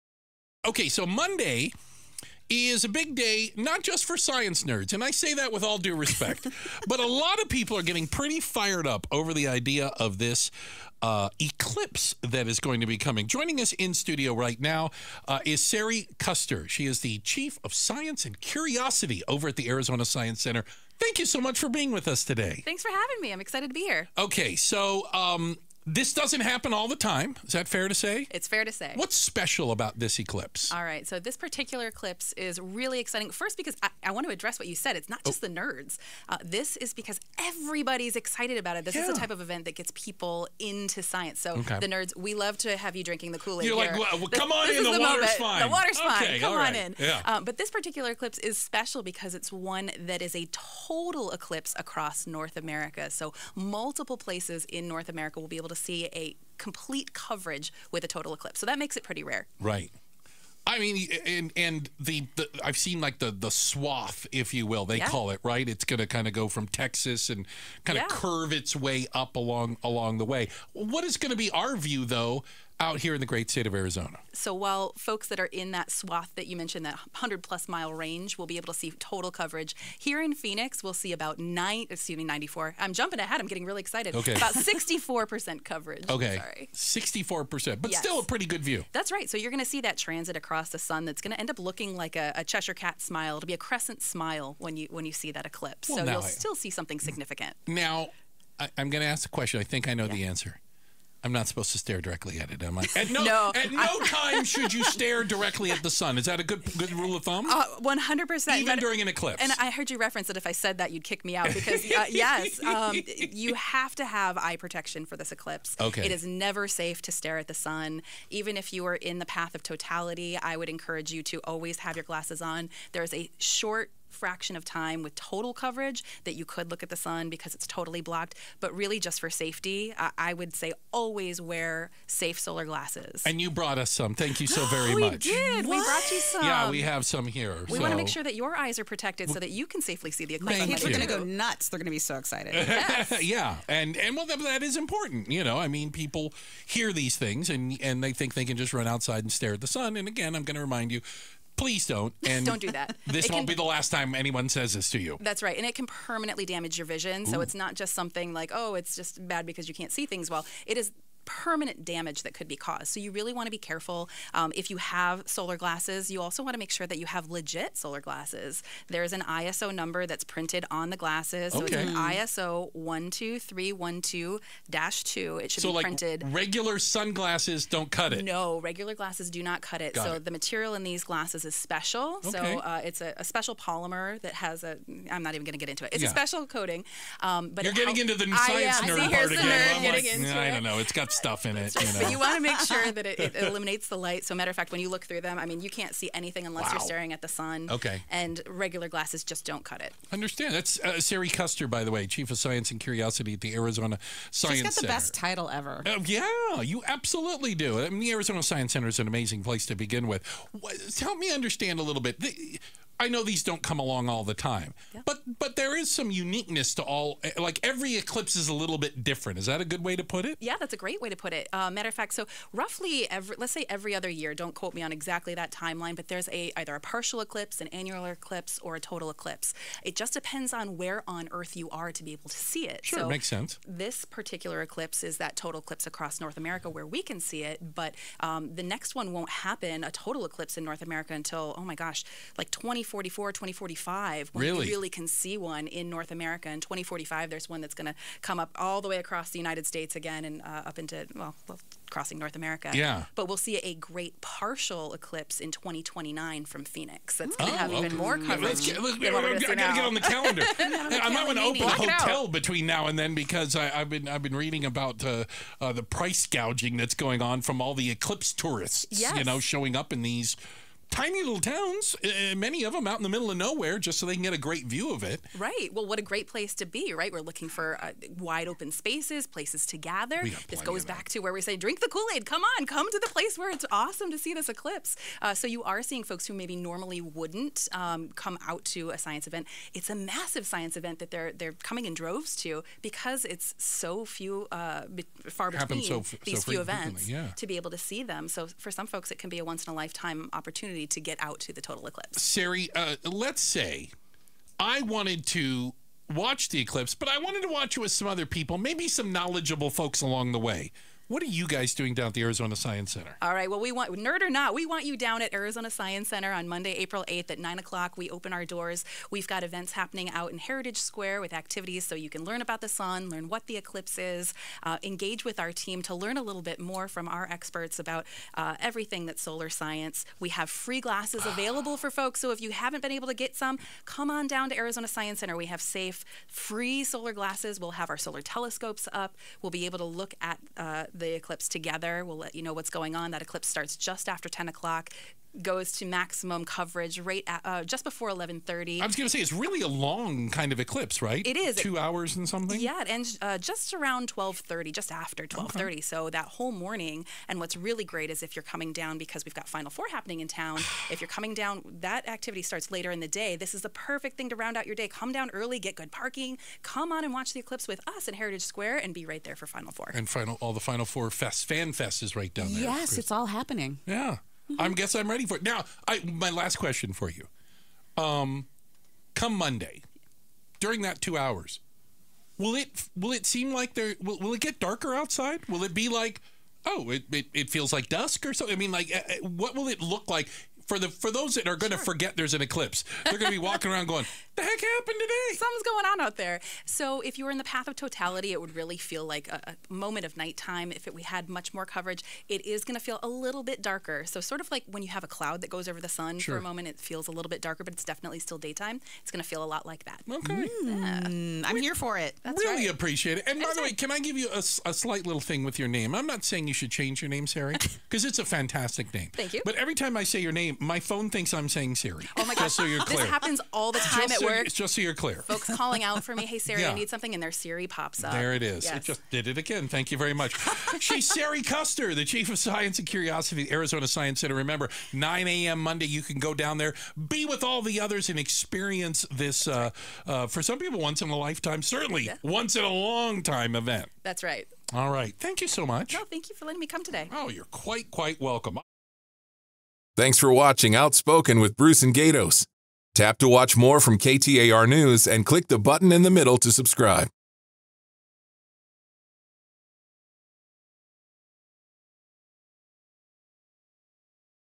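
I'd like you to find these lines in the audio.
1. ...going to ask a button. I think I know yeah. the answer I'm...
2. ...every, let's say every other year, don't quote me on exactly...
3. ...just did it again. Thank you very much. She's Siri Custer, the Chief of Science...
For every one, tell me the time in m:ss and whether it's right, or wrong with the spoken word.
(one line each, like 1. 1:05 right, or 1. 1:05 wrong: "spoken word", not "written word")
1. 1:38 wrong: "question", not "button"
2. 3:43 right
3. 7:08 right.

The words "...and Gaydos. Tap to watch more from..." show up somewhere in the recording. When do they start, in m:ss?
7:31.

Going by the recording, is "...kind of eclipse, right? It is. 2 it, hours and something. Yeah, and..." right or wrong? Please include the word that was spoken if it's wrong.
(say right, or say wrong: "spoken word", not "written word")
right.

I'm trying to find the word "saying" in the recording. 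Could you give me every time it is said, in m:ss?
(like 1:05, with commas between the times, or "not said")
6:56, 7:01.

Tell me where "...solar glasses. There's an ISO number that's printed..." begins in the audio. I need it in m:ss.
2:47.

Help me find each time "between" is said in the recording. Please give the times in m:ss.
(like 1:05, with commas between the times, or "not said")
4:22, 4:55.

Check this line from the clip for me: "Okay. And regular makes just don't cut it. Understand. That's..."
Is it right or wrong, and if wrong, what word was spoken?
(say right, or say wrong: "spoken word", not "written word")
wrong: "glasses", not "makes".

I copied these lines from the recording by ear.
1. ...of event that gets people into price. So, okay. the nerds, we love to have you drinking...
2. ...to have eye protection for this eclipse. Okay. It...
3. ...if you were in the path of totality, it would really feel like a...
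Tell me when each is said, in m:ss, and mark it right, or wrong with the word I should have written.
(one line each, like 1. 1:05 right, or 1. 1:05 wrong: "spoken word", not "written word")
1. 0:39 wrong: "science", not "price"
2. 1:53 right
3. 6:37 right.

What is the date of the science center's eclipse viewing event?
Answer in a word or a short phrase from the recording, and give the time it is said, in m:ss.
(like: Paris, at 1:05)
April 8th, at 5:16.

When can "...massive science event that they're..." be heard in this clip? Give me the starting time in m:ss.
4:49.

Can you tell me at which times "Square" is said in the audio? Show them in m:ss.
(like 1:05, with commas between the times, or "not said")
5:20, 6:08.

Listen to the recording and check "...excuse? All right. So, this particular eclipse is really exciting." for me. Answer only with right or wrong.
wrong.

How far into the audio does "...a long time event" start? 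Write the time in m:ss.
7:22.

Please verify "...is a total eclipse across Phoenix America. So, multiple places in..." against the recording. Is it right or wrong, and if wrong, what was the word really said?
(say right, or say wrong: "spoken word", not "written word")
wrong: "North", not "Phoenix".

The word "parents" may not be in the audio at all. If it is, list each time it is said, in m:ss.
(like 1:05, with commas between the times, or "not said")
not said.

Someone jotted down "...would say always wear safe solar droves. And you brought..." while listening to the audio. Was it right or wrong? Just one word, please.
wrong.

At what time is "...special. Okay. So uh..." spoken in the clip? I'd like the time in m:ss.
3:01.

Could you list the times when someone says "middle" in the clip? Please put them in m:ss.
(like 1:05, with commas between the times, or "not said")
4:33, 7:36.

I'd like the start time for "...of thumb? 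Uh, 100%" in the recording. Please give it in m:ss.
1:47.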